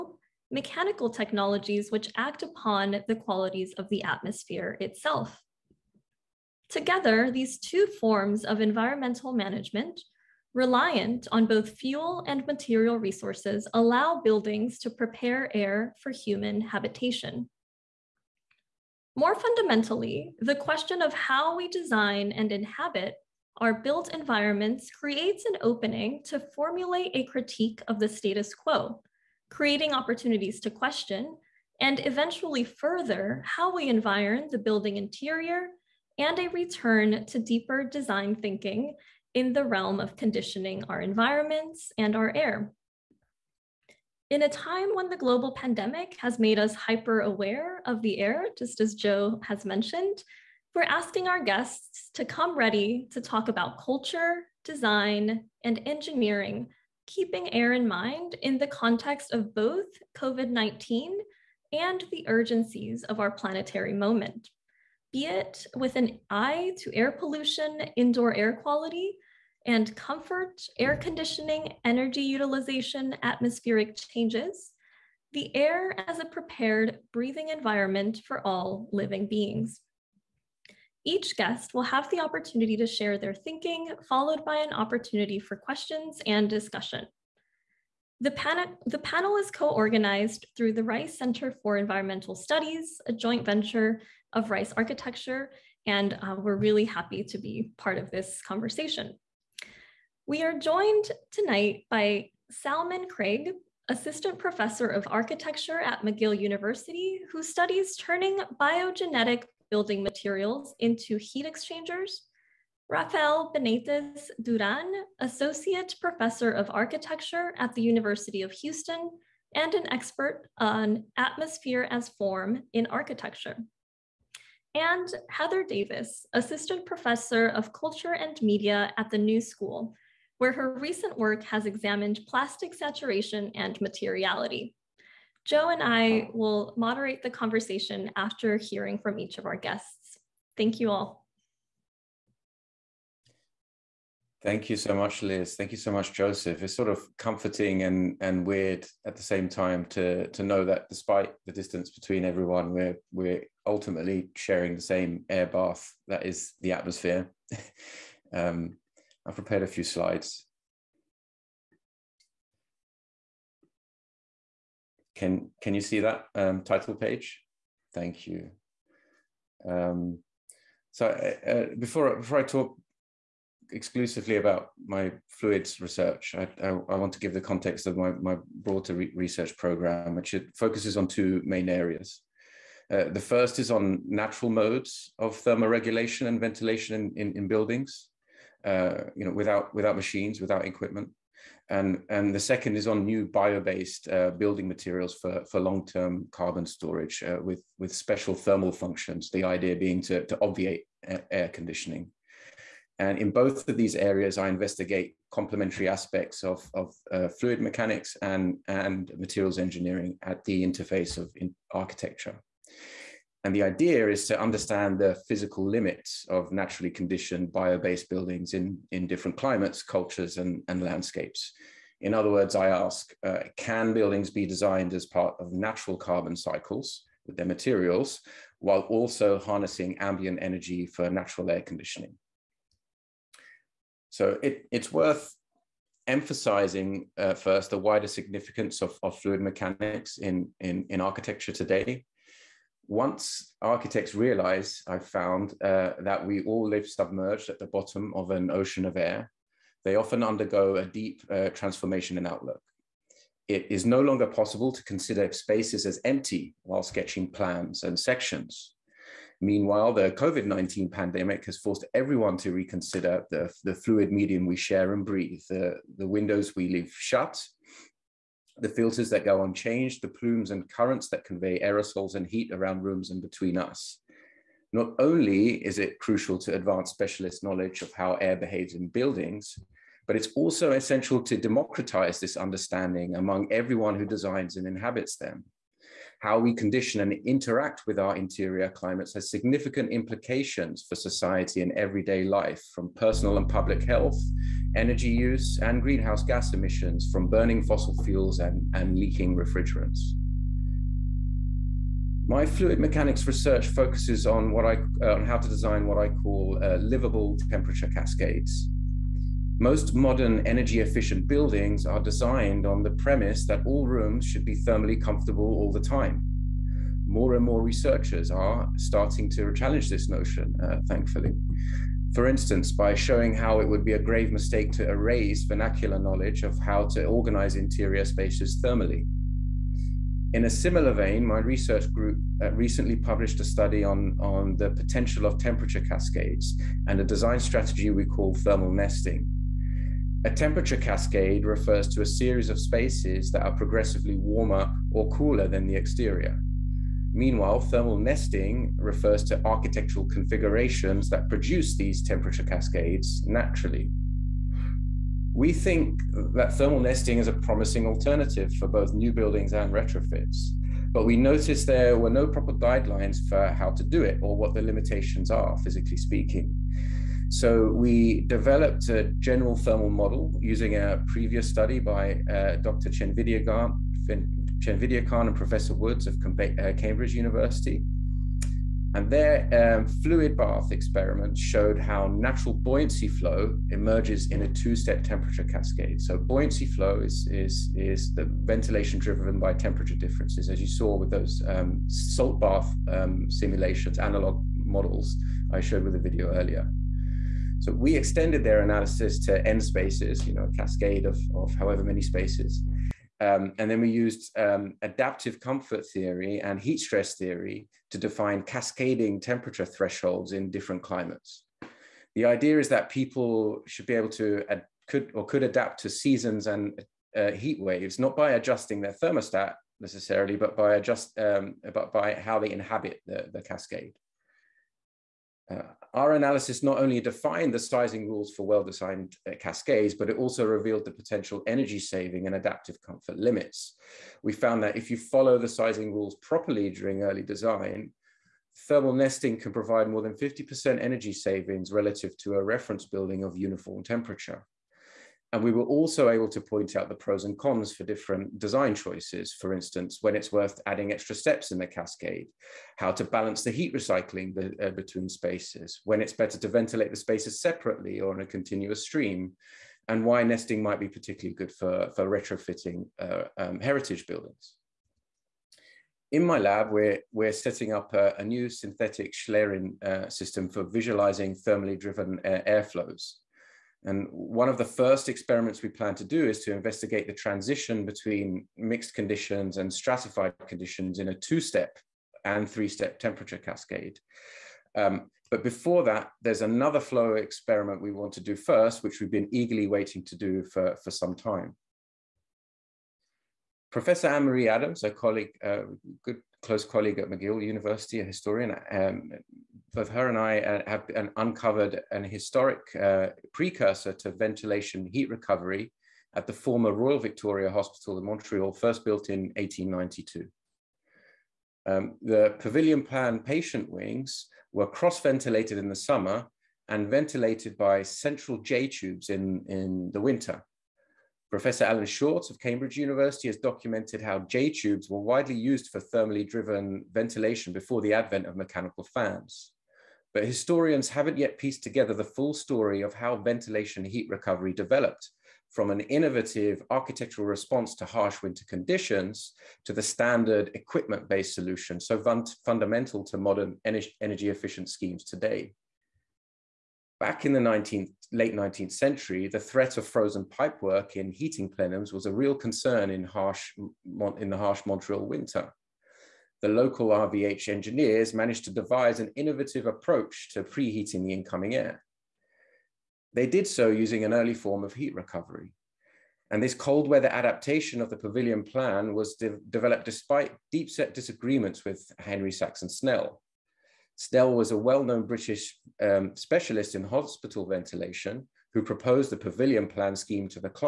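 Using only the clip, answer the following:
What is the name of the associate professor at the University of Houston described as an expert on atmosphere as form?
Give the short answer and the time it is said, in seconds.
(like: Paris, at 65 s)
Rafael Benitez Duran, at 112 s.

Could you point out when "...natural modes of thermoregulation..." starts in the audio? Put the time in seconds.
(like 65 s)
184 s.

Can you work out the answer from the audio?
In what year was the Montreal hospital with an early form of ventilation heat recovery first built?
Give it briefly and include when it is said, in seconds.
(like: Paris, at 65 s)
1892, at 509 s.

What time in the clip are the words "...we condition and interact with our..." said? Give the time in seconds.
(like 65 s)
286 s.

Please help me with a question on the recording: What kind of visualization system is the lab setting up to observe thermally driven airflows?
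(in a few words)
synthetic Schlieren.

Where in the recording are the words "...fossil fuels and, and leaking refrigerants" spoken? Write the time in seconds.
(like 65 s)
297 s.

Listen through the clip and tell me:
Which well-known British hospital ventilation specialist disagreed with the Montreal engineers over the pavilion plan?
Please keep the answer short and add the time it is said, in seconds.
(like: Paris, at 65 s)
Henry Saxon Snell, at 571 s.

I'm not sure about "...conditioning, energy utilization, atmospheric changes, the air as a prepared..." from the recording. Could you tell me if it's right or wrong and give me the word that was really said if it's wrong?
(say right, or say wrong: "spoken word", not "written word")
right.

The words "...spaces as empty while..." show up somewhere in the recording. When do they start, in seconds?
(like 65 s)
255 s.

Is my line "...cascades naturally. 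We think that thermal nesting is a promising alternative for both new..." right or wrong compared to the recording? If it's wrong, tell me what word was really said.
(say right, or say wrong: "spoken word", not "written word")
right.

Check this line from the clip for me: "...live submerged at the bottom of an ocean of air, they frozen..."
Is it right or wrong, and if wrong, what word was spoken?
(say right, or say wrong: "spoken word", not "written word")
wrong: "often", not "frozen".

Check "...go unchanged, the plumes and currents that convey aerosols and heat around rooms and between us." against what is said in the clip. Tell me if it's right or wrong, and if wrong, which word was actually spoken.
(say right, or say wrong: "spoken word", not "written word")
right.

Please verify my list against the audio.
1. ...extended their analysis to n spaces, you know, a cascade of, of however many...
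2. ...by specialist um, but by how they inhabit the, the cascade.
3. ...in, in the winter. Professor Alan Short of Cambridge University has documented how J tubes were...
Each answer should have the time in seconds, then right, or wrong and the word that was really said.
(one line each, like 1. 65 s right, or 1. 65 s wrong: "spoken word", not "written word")
1. 397 s right
2. 420 s wrong: "adjust", not "specialist"
3. 519 s right.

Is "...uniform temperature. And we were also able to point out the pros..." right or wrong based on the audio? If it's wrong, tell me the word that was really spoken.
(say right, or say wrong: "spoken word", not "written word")
right.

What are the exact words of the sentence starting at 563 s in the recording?
They did so using an early form of heat recovery.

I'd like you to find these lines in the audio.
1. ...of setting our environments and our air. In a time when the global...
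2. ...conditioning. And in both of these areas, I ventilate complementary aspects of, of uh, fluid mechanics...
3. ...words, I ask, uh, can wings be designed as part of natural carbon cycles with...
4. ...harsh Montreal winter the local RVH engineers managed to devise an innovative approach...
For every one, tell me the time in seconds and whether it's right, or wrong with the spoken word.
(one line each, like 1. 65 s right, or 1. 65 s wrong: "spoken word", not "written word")
1. 39 s wrong: "conditioning", not "setting"
2. 201 s wrong: "investigate", not "ventilate"
3. 222 s wrong: "buildings", not "wings"
4. 554 s right.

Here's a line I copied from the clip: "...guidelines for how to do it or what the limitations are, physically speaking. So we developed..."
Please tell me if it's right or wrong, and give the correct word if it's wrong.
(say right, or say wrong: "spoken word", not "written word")
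right.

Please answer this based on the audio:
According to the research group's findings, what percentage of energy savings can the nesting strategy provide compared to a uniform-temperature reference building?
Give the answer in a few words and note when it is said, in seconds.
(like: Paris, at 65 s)
more than 50%, at 439 s.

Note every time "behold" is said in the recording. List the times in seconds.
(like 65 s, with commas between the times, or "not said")
not said.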